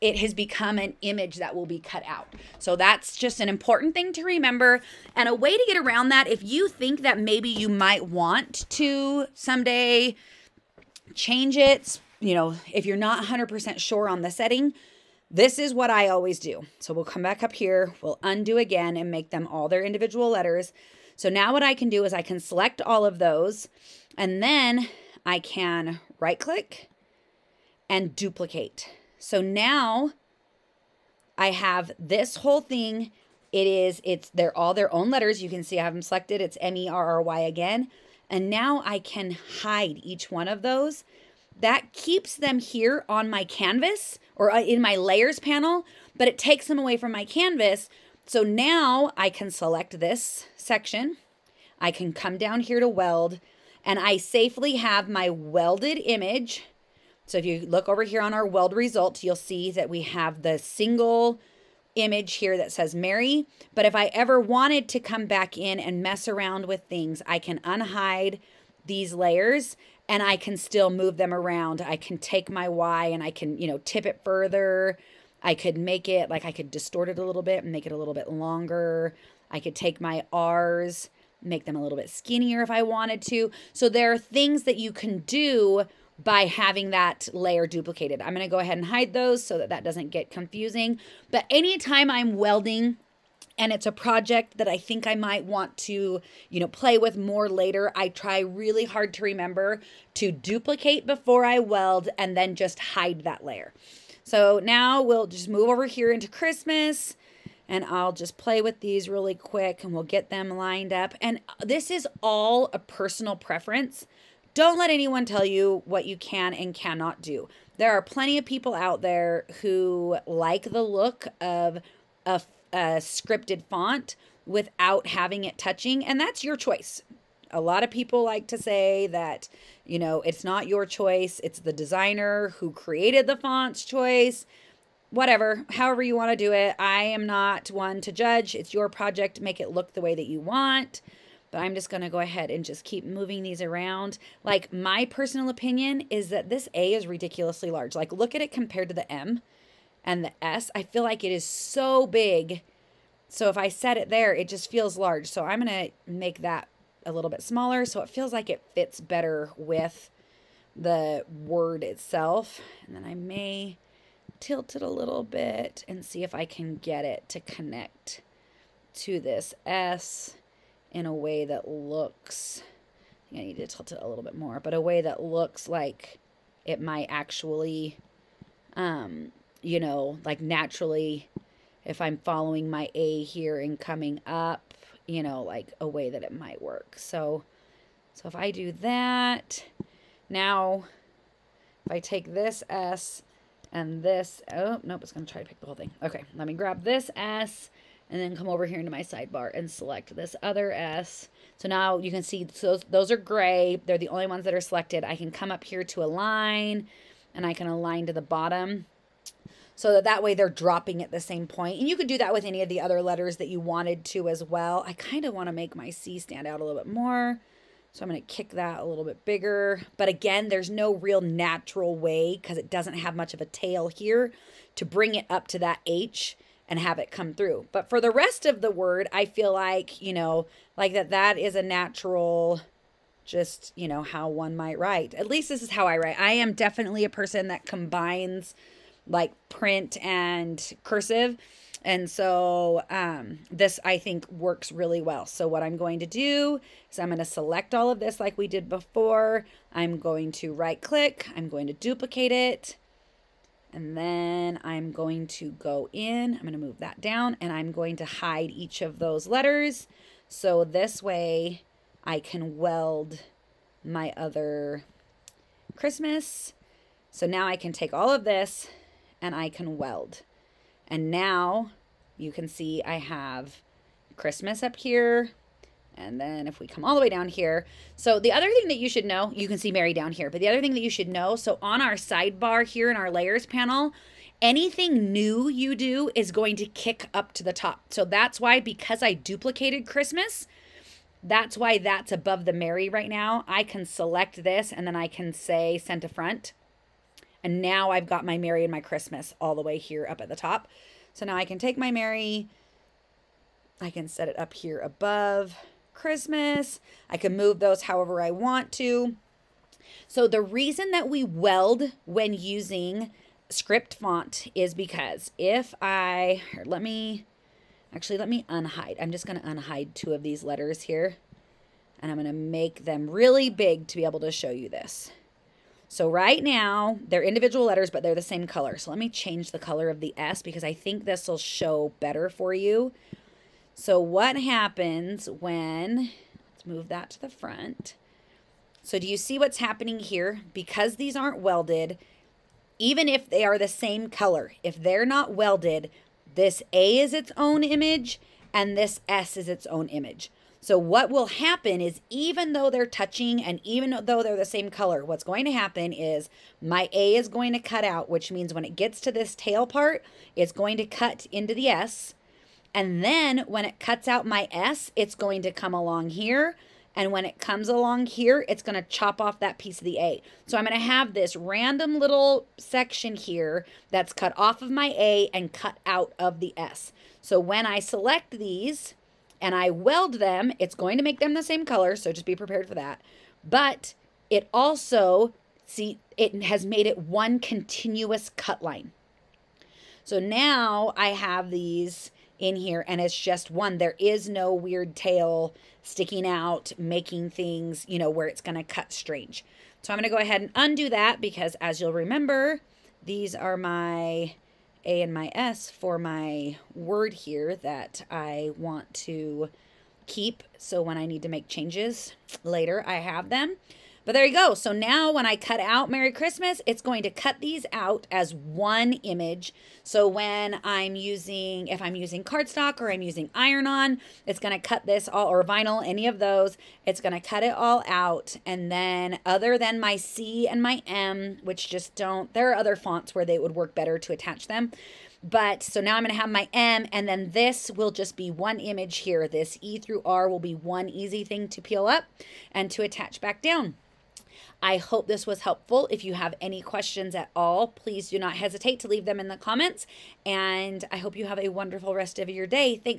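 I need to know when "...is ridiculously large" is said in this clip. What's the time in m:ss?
2:26.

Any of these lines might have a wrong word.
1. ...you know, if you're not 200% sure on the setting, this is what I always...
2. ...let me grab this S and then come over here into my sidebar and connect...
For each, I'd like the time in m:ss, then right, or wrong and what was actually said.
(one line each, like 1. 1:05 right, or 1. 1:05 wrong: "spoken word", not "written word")
1. 0:12 wrong: "100", not "200"
2. 3:16 wrong: "select", not "connect".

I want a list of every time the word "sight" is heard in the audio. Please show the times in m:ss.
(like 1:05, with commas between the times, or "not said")
not said.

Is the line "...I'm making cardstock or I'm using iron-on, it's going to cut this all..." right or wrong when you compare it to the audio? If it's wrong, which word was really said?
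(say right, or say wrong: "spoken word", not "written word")
wrong: "using", not "making".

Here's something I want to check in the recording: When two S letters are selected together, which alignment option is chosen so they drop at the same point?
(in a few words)
Align to the bottom.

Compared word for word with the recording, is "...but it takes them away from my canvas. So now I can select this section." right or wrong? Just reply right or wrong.
right.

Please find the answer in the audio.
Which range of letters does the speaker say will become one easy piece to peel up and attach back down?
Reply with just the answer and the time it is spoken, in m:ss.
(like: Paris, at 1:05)
E through R, at 7:19.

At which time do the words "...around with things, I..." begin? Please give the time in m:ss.
1:06.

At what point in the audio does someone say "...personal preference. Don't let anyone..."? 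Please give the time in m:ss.
1:52.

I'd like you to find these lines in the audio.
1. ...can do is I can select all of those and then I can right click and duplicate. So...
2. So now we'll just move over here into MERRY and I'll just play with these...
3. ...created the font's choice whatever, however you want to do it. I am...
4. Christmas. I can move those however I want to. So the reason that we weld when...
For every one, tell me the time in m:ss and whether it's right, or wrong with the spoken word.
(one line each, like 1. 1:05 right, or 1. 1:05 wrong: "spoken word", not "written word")
1. 0:21 right
2. 1:44 wrong: "Christmas", not "MERRY"
3. 2:12 right
4. 5:05 right.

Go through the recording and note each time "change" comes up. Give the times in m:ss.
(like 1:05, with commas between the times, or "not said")
0:11, 5:29, 6:51.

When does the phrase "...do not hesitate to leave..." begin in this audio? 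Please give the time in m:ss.
7:28.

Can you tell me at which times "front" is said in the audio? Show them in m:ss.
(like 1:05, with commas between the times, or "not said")
4:56, 5:37.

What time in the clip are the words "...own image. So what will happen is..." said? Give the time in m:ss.
5:49.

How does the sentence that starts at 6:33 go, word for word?
There is no weird tail sticking out, making things, you know, where it's going to cut strange.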